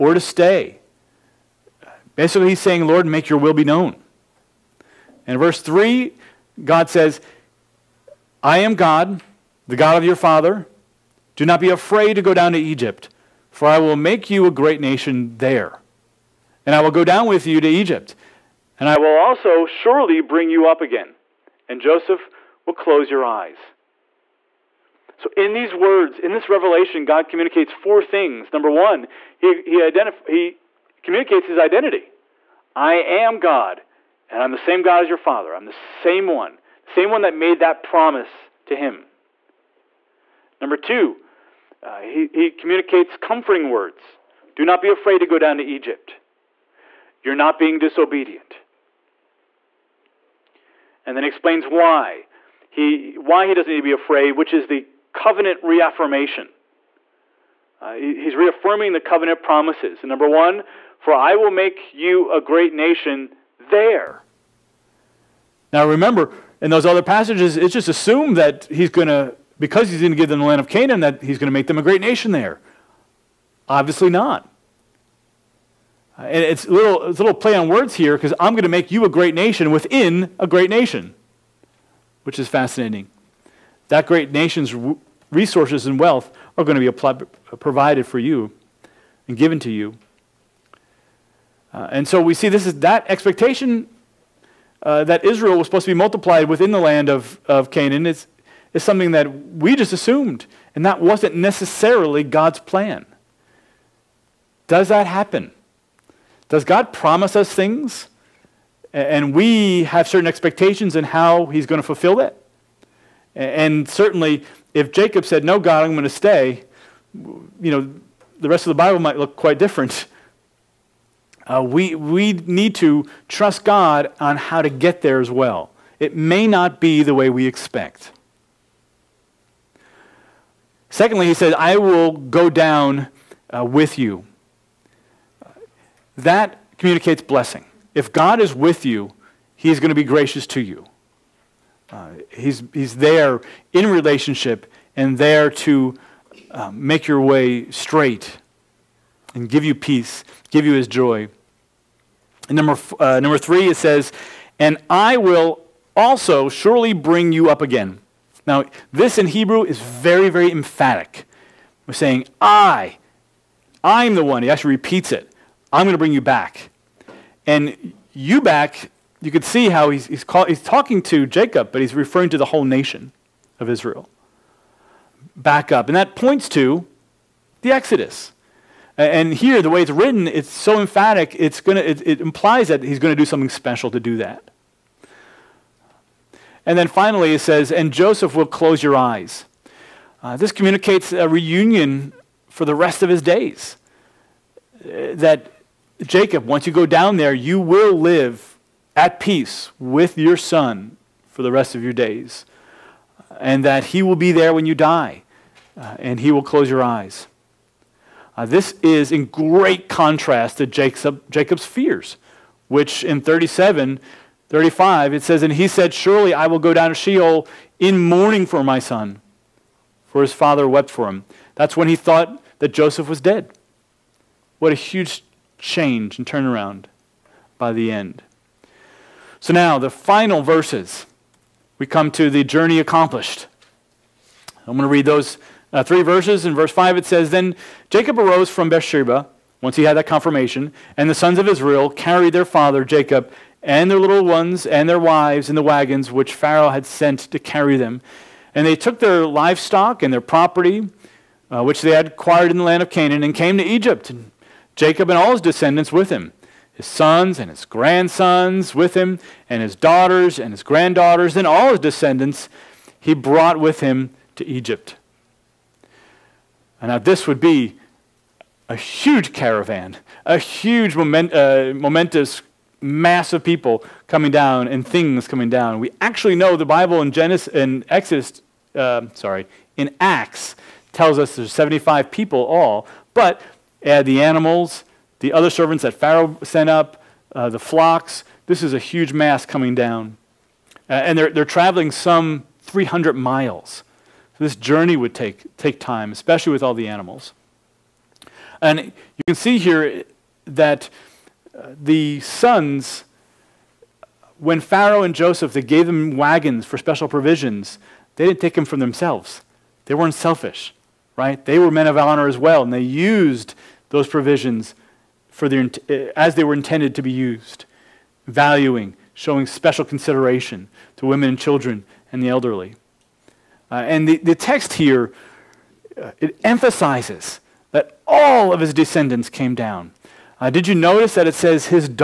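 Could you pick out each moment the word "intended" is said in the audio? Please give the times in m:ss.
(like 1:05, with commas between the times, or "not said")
5:16.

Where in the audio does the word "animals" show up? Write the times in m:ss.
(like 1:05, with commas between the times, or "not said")
4:44, 4:56.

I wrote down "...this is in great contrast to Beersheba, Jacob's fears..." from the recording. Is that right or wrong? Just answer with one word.
wrong.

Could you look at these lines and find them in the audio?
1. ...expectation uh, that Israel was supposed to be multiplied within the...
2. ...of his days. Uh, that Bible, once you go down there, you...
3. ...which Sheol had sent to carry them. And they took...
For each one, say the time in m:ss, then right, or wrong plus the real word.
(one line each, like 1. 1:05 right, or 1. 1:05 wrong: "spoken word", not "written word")
1. 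1:33 right
2. 3:13 wrong: "Jacob", not "Bible"
3. 4:06 wrong: "Pharaoh", not "Sheol".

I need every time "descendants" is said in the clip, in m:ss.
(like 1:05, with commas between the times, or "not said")
4:15, 4:21, 5:28.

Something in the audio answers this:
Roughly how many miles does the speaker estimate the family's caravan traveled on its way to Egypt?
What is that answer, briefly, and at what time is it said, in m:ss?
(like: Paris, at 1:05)
300, at 4:52.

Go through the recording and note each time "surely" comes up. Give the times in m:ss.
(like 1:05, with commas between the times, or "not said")
0:19, 2:36, 3:35.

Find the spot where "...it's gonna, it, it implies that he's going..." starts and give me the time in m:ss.
3:01.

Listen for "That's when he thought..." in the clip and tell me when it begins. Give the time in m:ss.
3:41.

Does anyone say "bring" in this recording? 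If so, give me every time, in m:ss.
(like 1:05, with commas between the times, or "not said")
0:20, 2:36, 2:45.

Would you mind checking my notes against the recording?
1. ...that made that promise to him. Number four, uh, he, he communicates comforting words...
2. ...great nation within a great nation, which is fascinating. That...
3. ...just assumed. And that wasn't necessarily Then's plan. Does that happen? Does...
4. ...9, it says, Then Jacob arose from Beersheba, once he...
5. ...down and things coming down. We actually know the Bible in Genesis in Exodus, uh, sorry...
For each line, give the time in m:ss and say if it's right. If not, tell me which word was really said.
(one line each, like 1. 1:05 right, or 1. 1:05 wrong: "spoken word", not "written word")
1. 0:37 wrong: "two", not "four"
2. 1:19 right
3. 1:39 wrong: "God", not "Then"
4. 3:56 wrong: "5", not "9"
5. 4:34 right.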